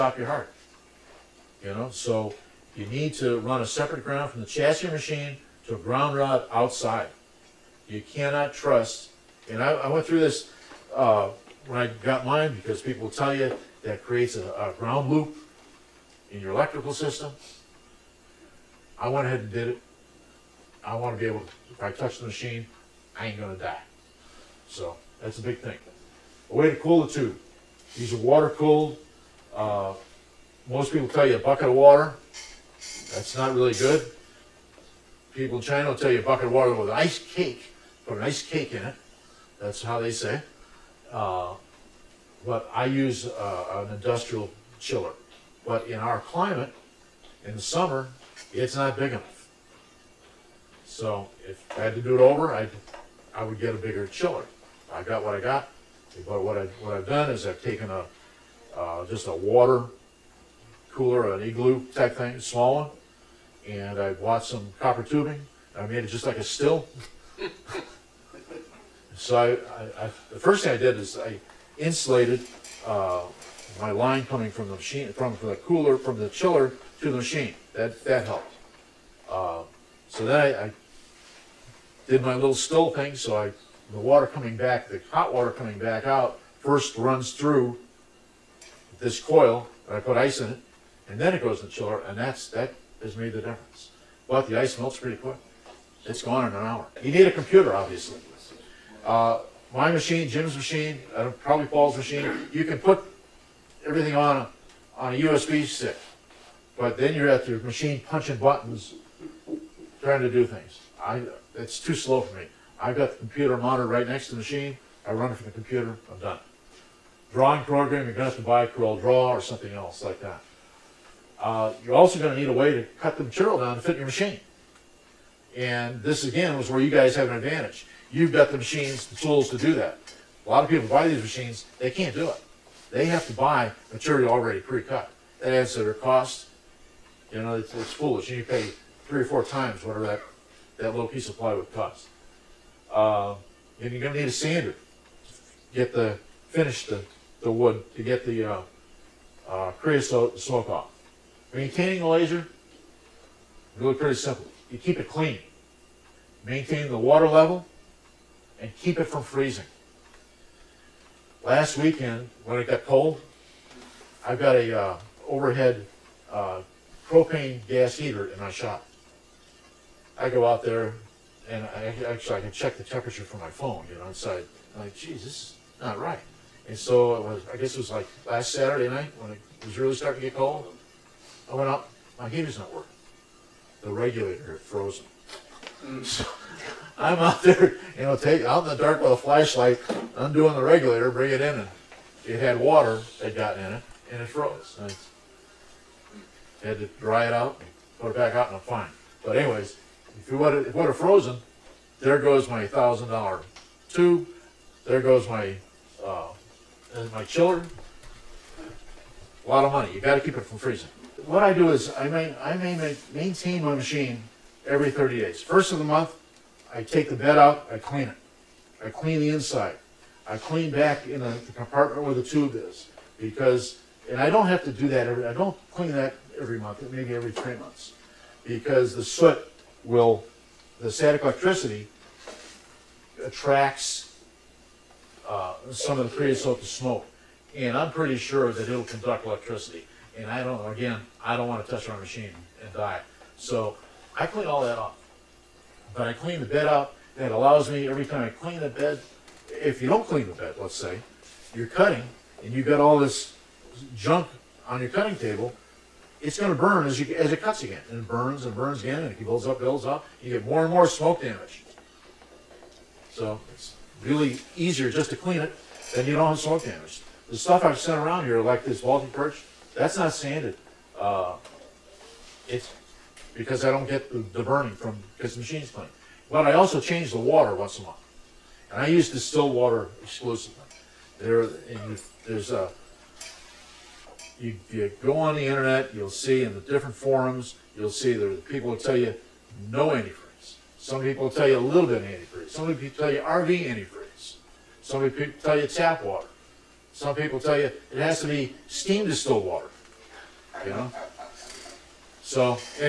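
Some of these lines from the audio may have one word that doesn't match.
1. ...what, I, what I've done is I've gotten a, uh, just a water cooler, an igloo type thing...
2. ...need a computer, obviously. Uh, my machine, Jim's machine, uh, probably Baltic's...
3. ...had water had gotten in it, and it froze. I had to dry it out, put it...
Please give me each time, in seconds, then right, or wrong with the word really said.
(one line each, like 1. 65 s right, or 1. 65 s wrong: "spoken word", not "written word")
1. 56 s wrong: "taken", not "gotten"
2. 97 s wrong: "Paul", not "Baltic"
3. 192 s right.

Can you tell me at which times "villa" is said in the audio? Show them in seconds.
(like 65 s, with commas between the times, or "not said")
not said.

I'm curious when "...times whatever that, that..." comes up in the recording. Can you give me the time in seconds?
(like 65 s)
139 s.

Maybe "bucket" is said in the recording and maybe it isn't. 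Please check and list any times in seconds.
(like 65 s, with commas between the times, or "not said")
31 s, 36 s.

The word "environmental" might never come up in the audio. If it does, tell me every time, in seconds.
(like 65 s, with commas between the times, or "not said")
not said.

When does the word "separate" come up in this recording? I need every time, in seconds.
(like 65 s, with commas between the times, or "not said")
3 s.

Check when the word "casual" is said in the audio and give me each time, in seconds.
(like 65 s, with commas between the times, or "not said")
not said.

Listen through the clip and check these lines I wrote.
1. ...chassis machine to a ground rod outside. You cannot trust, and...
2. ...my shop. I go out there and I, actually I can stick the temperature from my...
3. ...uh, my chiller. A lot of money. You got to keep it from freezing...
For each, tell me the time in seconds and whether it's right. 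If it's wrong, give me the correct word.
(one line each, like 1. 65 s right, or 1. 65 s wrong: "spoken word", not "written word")
1. 4 s right
2. 168 s wrong: "check", not "stick"
3. 206 s right.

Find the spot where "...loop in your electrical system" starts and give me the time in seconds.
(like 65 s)
15 s.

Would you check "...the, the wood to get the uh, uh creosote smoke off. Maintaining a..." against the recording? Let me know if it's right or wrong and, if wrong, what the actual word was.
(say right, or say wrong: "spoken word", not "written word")
right.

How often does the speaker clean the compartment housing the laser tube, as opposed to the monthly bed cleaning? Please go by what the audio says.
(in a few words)
every 3 months.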